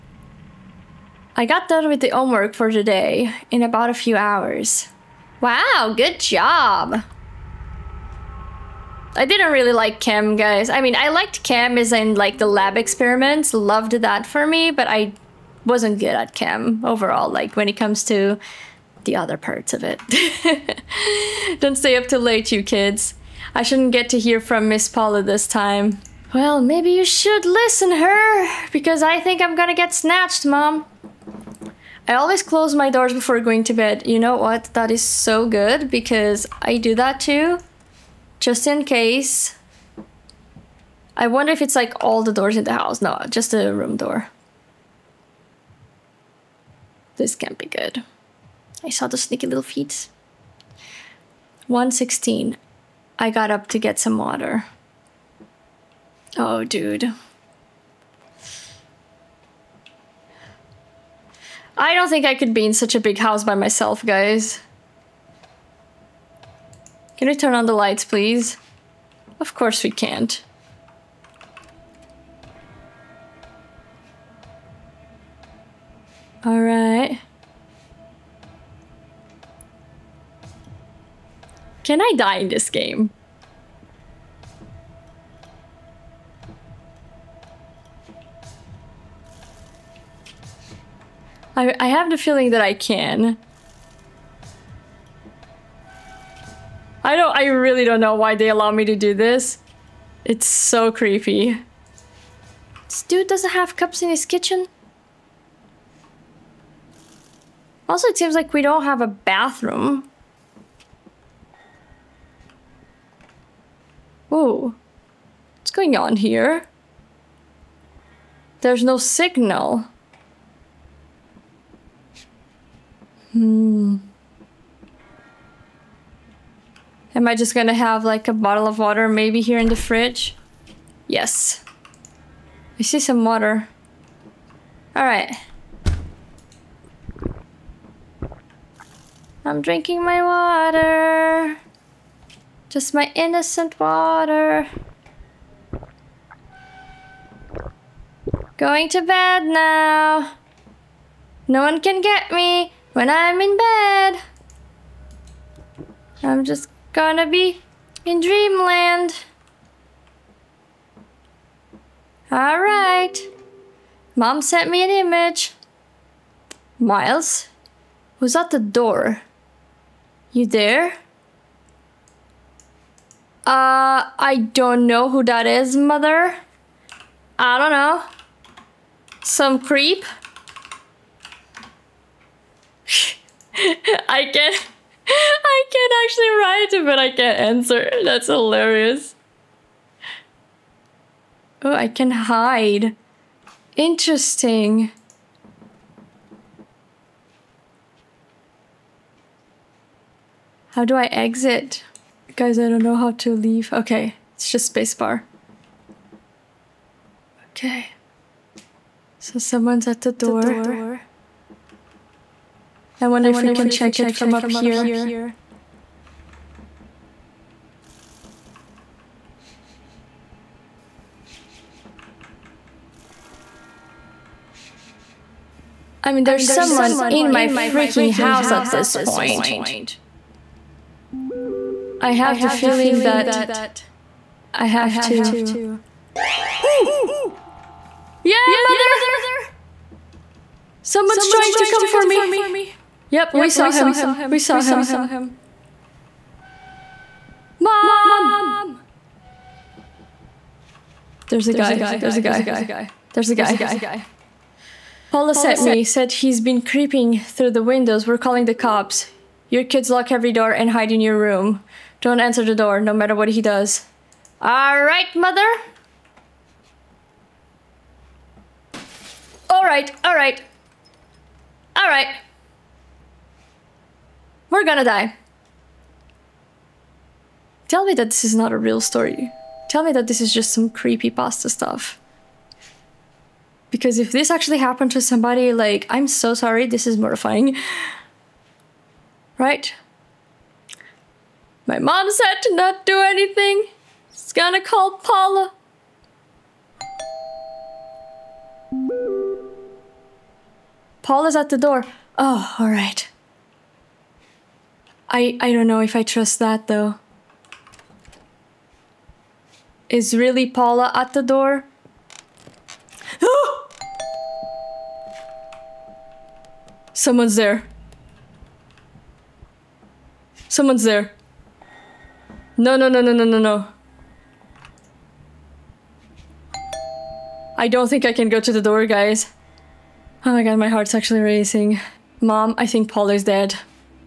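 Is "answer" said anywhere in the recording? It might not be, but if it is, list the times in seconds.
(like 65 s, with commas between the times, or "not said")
187 s, 262 s.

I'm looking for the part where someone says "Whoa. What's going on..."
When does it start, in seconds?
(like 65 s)
114 s.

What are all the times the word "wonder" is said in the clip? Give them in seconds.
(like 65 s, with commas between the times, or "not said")
41 s, 213 s.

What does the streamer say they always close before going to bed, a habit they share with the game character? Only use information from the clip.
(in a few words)
room door.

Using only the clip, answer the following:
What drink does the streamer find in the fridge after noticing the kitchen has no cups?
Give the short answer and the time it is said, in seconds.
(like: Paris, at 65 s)
bottle of water, at 128 s.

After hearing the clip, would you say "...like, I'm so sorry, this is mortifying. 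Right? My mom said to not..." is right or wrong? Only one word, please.
right.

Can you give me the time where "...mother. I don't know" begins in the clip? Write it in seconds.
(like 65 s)
175 s.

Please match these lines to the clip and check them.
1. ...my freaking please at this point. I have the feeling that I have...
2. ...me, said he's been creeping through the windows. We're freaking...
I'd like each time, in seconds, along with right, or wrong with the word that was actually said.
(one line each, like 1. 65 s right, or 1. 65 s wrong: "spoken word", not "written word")
1. 227 s wrong: "house", not "please"
2. 255 s wrong: "calling", not "freaking".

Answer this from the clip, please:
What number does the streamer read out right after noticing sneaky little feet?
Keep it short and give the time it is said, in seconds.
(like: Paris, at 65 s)
116, at 51 s.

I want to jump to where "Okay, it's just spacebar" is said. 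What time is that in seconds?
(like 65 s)
203 s.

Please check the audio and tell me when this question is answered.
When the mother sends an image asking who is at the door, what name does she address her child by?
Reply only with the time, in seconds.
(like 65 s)
166 s.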